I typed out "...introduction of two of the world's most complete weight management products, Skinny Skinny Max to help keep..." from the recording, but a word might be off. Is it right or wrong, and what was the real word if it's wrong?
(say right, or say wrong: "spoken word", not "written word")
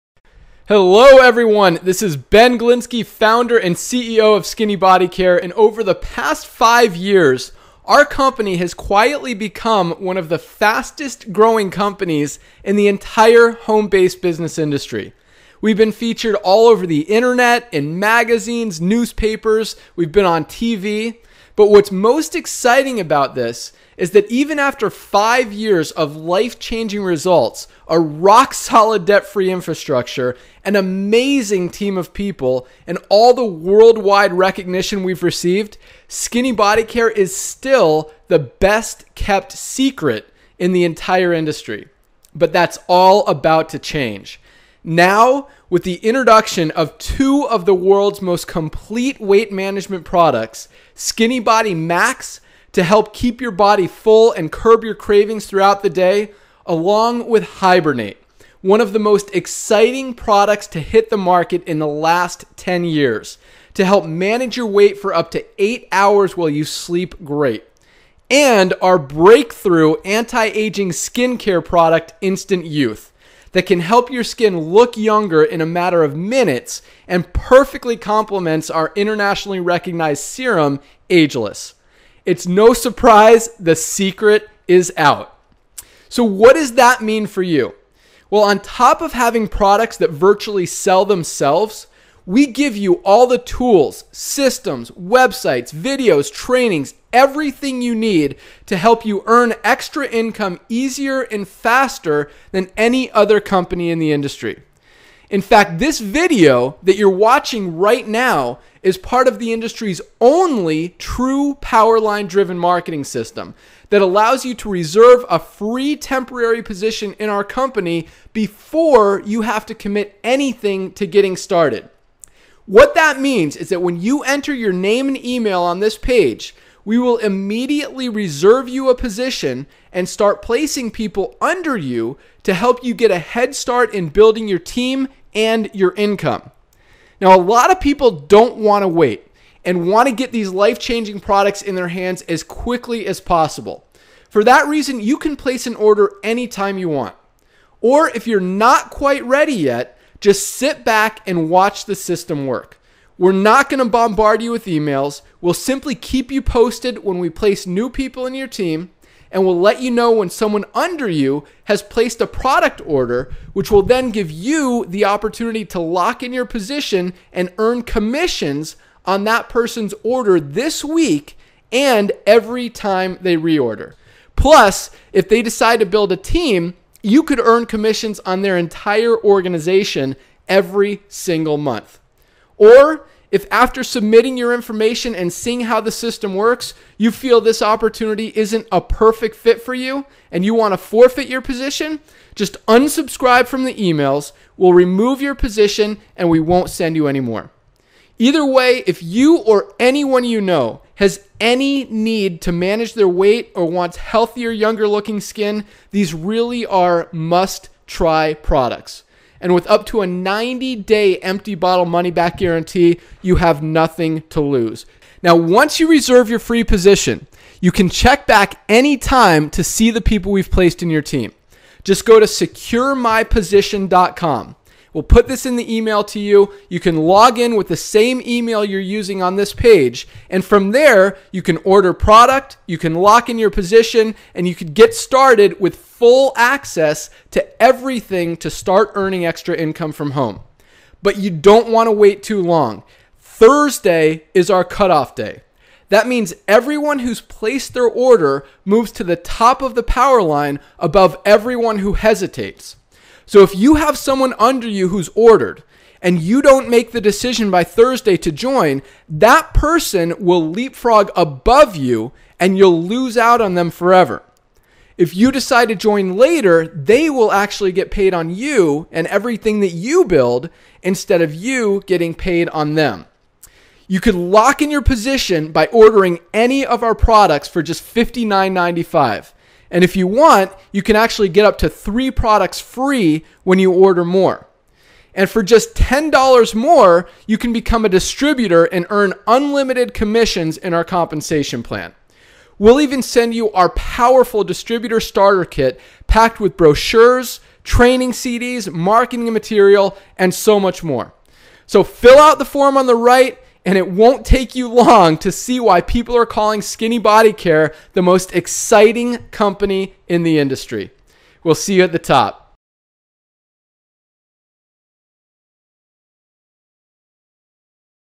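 wrong: "Body", not "Skinny".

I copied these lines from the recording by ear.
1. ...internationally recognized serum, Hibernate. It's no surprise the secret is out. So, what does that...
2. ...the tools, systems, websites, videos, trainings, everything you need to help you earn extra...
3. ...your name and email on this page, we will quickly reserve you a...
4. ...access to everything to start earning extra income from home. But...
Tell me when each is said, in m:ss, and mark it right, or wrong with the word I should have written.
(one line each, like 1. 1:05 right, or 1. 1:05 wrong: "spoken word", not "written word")
1. 1:18 wrong: "Ageless", not "Hibernate"
2. 1:33 right
3. 2:04 wrong: "immediately", not "quickly"
4. 3:56 right.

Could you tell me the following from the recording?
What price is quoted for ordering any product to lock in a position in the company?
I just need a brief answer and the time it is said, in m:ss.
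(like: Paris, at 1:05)
$59.95, at 4:37.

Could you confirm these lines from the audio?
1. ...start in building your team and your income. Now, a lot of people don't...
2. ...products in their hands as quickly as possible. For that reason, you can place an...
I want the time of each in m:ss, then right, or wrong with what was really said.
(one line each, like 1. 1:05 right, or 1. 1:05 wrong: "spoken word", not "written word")
1. 2:13 right
2. 2:21 right.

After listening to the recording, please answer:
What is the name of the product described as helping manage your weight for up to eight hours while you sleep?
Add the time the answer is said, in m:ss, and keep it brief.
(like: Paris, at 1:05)
Hibernate, at 0:57.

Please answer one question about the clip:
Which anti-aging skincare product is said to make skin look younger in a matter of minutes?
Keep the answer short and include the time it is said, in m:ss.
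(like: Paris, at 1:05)
Instant Youth, at 1:12.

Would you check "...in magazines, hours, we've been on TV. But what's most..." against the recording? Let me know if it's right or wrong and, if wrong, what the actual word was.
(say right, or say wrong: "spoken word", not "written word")
wrong: "newspapers", not "hours".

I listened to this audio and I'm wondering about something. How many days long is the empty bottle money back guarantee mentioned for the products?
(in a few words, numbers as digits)
90.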